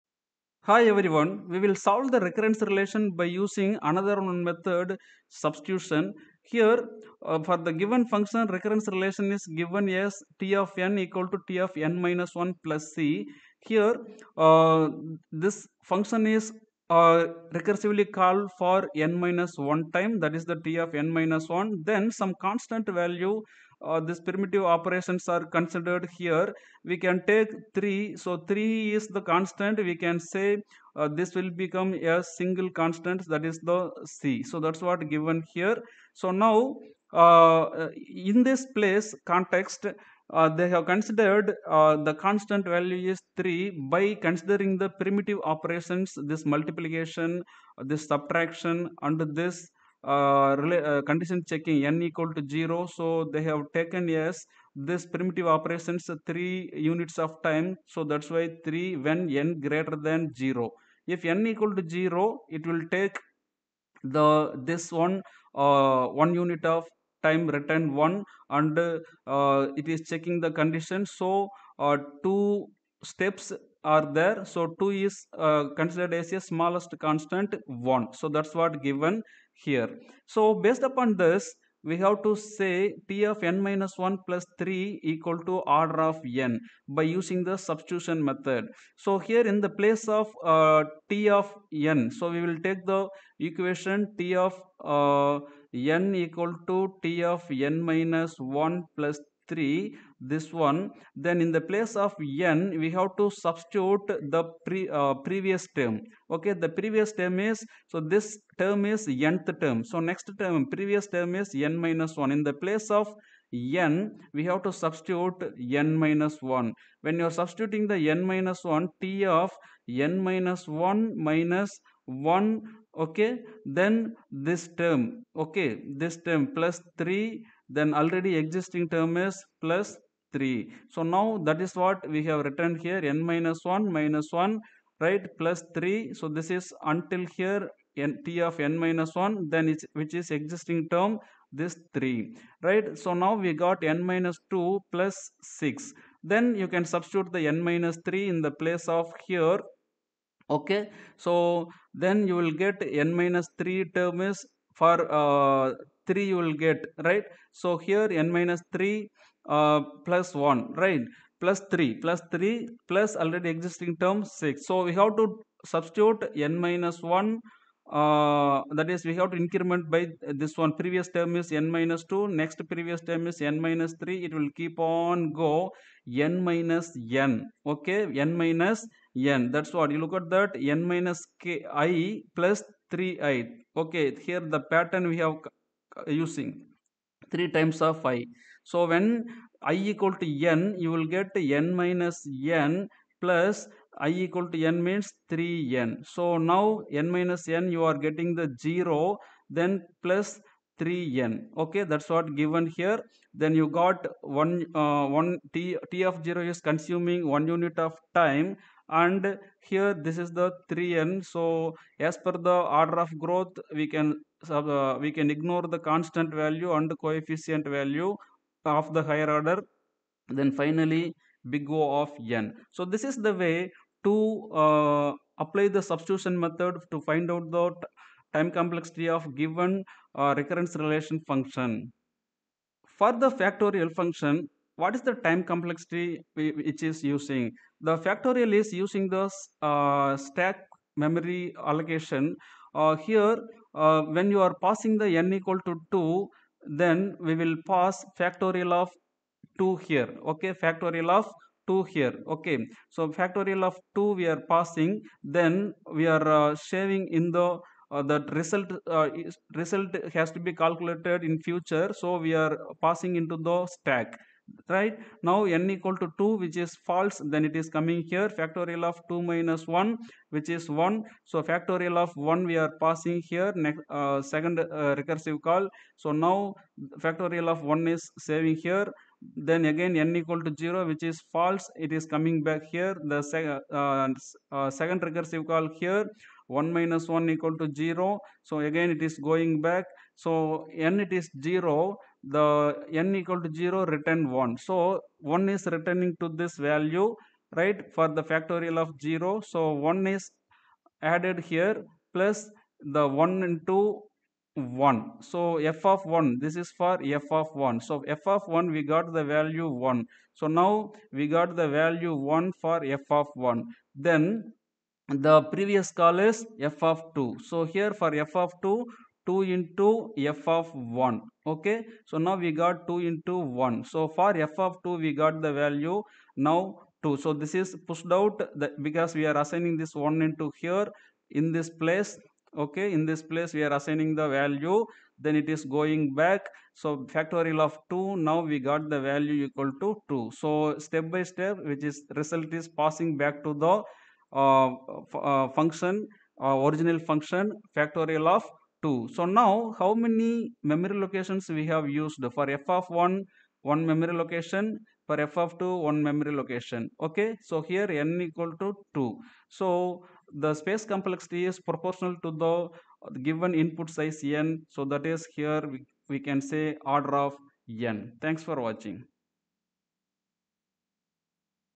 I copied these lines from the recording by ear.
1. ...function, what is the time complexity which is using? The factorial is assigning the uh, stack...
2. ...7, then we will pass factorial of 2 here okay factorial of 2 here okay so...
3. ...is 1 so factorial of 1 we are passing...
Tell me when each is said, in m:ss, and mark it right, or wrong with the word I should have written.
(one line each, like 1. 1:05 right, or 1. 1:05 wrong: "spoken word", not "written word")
1. 3:53 wrong: "using", not "assigning"
2. 4:05 wrong: "2", not "7"
3. 4:30 right.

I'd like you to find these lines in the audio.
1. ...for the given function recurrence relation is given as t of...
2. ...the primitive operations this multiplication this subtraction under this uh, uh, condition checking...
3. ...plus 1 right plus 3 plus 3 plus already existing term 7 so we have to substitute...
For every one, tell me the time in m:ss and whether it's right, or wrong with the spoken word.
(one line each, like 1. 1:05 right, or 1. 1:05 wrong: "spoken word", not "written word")
1. 0:07 right
2. 0:44 right
3. 2:40 wrong: "6", not "7".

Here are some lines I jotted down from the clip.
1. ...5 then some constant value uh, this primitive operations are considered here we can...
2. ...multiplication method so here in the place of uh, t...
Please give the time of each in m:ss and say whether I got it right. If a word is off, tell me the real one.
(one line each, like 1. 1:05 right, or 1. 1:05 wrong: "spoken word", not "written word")
1. 0:21 wrong: "1", not "5"
2. 1:27 wrong: "substitution", not "multiplication".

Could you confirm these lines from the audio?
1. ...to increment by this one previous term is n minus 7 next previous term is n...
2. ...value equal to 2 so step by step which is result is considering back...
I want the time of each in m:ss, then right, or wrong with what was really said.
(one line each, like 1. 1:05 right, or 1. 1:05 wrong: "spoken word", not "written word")
1. 2:49 wrong: "2", not "7"
2. 5:38 wrong: "passing", not "considering".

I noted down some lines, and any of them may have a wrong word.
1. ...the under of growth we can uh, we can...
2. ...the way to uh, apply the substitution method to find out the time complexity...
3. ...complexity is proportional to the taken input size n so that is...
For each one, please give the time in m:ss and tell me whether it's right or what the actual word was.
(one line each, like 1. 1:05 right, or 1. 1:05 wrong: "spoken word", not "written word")
1. 3:32 wrong: "order", not "under"
2. 3:43 right
3. 6:00 wrong: "given", not "taken".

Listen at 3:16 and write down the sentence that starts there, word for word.
So now n minus n you are getting the 0 then plus 3n.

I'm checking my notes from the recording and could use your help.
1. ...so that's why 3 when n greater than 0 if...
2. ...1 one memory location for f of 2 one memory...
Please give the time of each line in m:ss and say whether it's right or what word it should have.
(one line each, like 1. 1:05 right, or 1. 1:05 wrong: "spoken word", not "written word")
1. 0:57 right
2. 5:52 right.